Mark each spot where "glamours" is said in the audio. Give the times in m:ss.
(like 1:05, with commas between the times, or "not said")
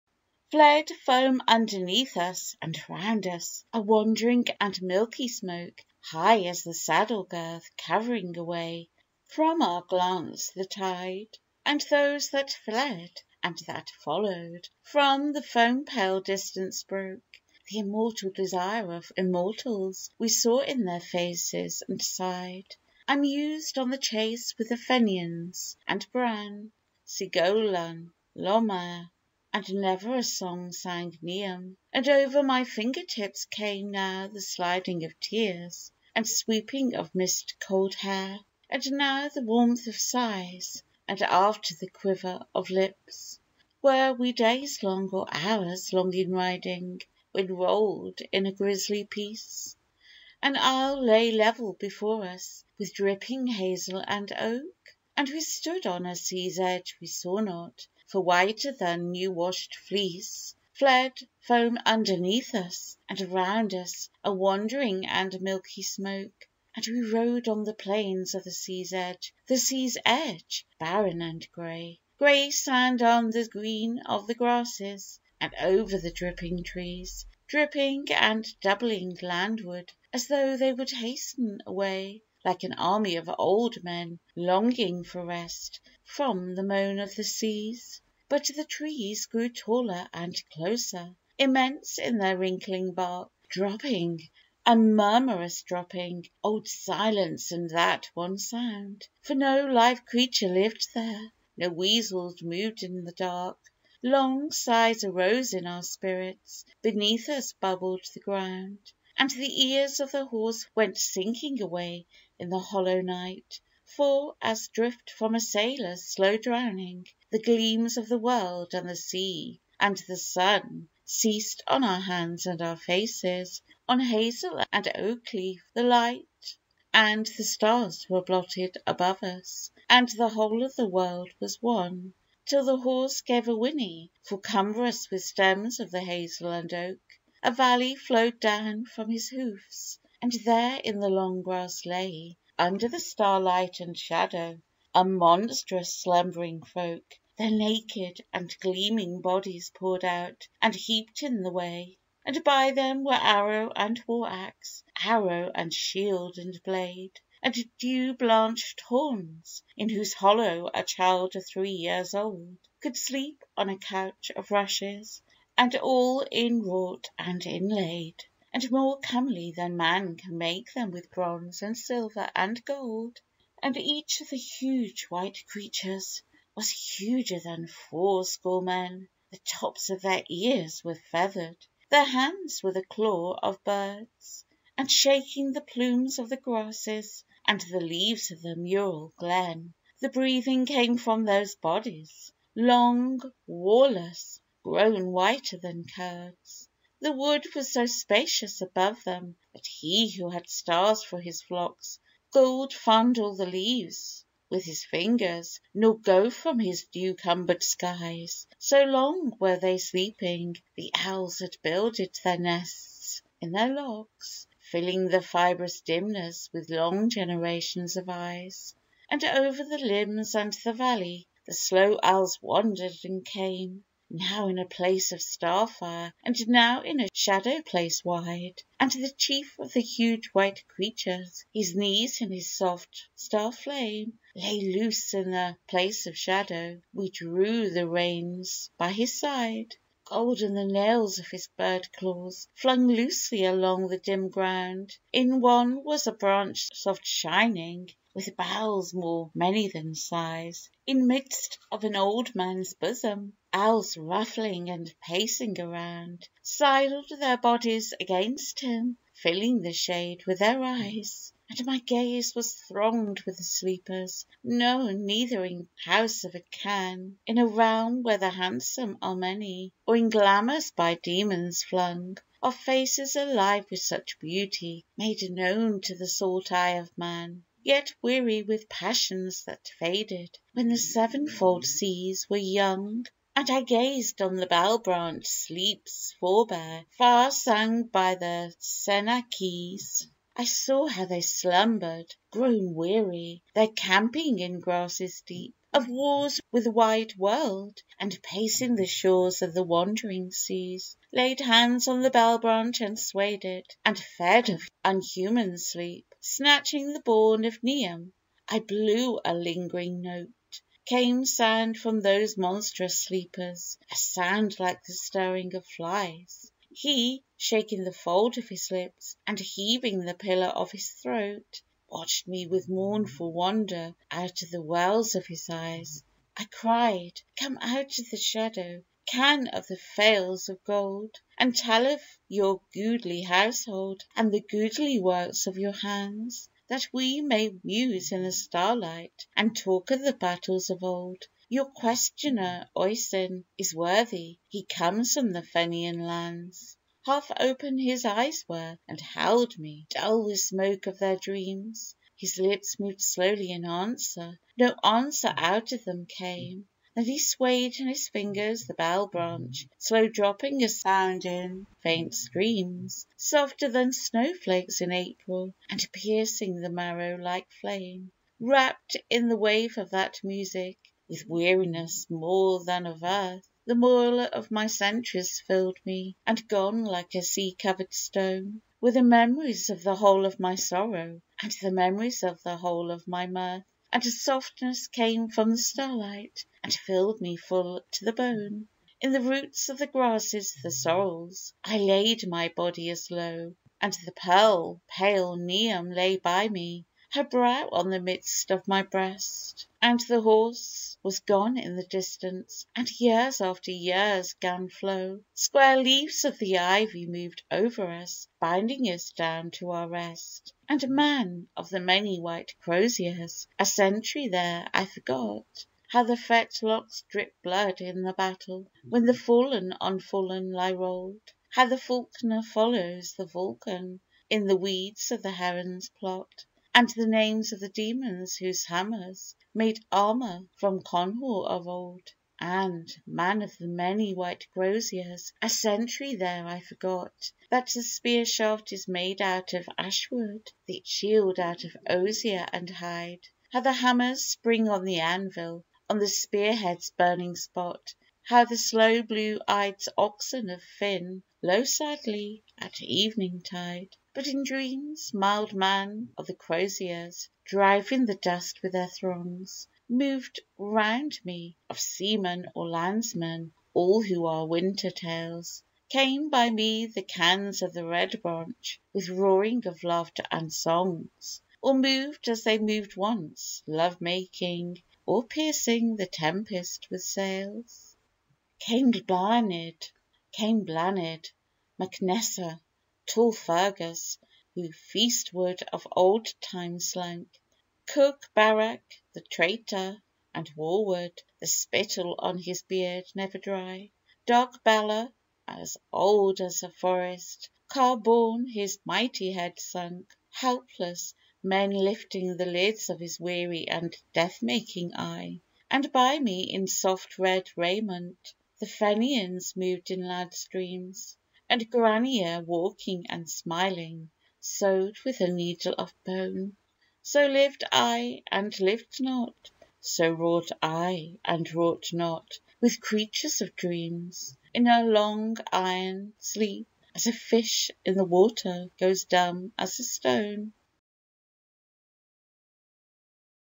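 4:30.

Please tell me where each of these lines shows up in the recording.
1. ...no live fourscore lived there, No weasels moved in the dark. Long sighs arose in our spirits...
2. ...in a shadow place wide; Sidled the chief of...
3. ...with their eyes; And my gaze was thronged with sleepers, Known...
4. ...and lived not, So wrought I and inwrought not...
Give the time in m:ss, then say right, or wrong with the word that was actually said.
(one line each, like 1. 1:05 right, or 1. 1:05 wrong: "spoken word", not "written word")
1. 1:39 wrong: "creature", not "fourscore"
2. 3:46 wrong: "And", not "Sidled"
3. 4:20 right
4. 8:38 wrong: "wrought", not "inwrought".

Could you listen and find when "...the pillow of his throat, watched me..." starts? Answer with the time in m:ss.
5:20.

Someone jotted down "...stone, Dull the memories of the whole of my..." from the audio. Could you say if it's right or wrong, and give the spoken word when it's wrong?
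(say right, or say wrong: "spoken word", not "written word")
wrong: "Were", not "Dull".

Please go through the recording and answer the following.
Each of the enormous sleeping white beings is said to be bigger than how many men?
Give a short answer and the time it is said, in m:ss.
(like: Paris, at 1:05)
fourscore, at 2:57.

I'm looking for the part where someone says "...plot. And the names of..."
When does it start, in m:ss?
7:05.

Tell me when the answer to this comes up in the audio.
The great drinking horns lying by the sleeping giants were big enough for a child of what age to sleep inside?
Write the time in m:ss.
2:41.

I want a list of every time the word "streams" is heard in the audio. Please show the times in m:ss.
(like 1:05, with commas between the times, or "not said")
6:02, 8:30.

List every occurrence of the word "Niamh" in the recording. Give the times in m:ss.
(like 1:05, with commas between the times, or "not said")
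0:31, 5:07, 6:35.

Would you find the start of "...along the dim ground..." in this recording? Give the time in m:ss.
4:03.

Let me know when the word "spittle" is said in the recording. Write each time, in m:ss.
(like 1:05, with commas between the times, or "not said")
8:11.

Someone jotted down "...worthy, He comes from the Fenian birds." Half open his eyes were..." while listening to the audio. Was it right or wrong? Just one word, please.
wrong.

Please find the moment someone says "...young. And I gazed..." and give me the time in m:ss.
4:42.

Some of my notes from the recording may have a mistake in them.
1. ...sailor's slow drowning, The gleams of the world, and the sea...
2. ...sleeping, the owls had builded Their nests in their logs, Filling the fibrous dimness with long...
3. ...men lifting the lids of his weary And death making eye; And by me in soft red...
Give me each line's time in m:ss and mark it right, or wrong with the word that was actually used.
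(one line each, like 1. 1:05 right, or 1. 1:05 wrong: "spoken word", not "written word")
1. 1:55 right
2. 3:29 right
3. 8:21 right.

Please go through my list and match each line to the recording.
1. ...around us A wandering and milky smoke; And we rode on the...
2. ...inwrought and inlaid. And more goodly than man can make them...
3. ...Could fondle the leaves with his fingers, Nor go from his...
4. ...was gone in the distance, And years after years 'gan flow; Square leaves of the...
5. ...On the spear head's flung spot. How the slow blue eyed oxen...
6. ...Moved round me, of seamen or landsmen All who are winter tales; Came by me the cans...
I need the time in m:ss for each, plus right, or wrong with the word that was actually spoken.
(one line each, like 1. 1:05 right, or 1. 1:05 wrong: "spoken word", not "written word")
1. 1:03 right
2. 2:46 wrong: "comely", not "goodly"
3. 3:22 right
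4. 6:41 right
5. 7:25 wrong: "burning", not "flung"
6. 7:39 right.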